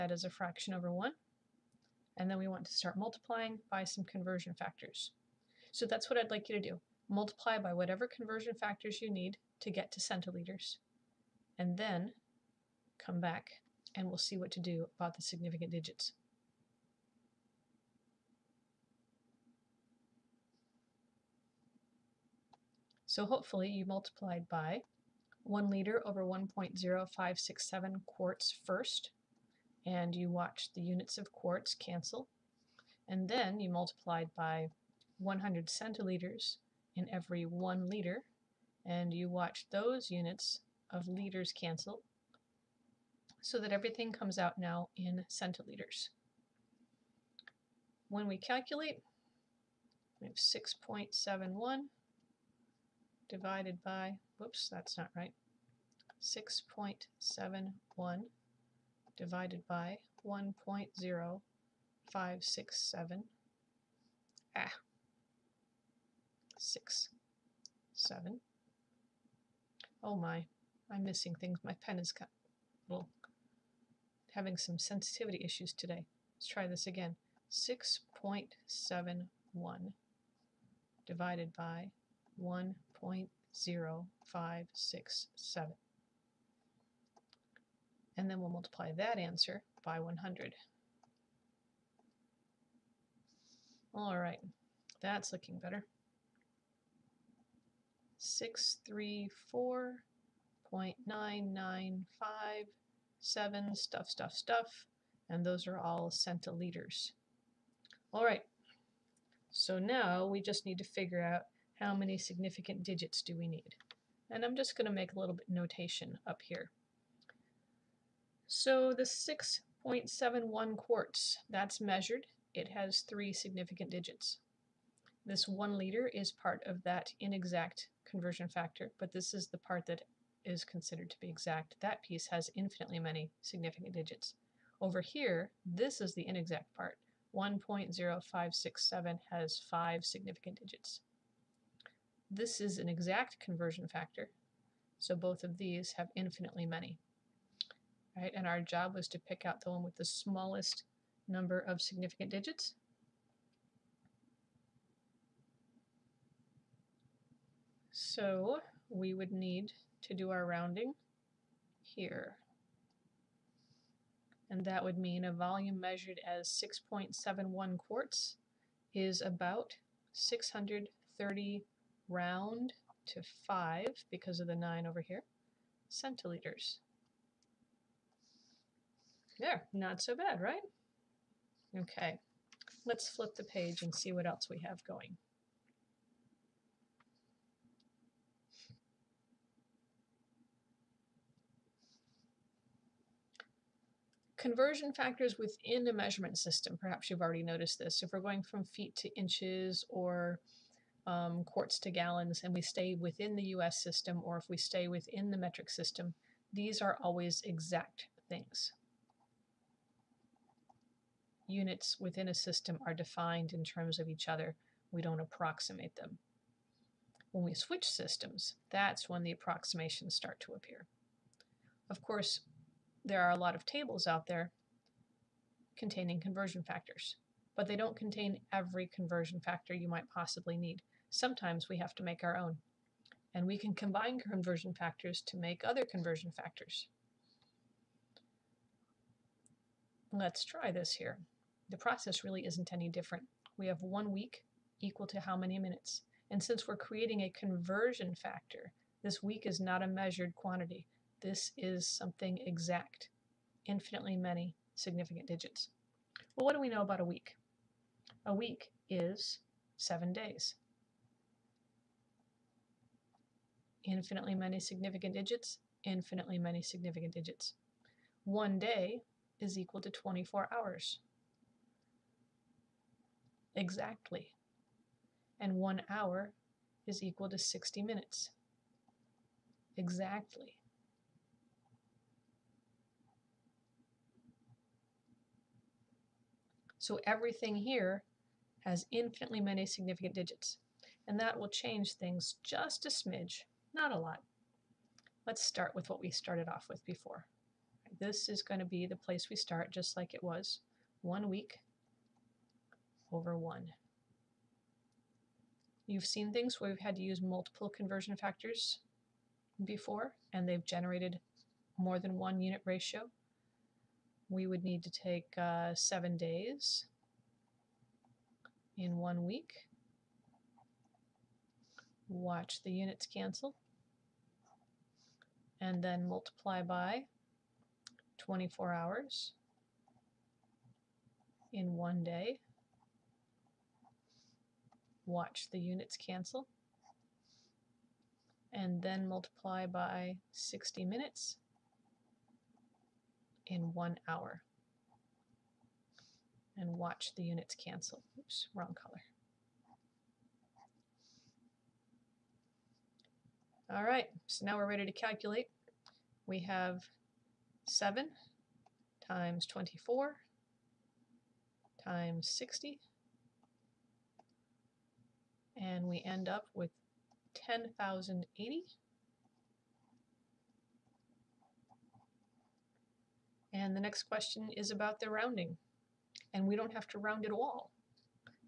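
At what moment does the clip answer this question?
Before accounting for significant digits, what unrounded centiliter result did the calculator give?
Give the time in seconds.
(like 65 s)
98 s.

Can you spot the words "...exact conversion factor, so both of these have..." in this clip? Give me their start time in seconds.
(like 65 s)
142 s.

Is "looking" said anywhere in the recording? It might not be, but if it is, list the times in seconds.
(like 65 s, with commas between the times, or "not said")
95 s.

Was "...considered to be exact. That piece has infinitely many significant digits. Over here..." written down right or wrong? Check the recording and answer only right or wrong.
right.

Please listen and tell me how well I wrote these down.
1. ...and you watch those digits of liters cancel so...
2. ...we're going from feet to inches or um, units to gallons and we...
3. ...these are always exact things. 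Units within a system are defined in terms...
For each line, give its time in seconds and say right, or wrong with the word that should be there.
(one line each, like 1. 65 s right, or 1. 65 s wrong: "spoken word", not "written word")
1. 38 s wrong: "units", not "digits"
2. 198 s wrong: "quarts", not "units"
3. 206 s right.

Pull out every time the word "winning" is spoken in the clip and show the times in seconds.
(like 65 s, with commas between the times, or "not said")
not said.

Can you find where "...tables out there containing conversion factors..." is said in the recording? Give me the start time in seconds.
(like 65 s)
223 s.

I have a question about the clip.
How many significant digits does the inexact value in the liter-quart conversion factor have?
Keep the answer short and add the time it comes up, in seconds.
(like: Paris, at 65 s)
five, at 139 s.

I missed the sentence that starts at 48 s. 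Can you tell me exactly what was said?
When we calculate, we have 6.71 divided by, whoops, that's not right, 6.71 divided by 1.0567.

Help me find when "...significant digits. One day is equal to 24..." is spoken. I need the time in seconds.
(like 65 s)
266 s.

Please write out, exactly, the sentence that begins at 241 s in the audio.
The process really isn't any different.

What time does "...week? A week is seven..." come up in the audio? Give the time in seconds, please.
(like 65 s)
257 s.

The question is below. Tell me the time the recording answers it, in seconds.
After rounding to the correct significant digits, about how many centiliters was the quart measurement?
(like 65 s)
170 s.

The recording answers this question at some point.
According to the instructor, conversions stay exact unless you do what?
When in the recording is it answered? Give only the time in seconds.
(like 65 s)
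217 s.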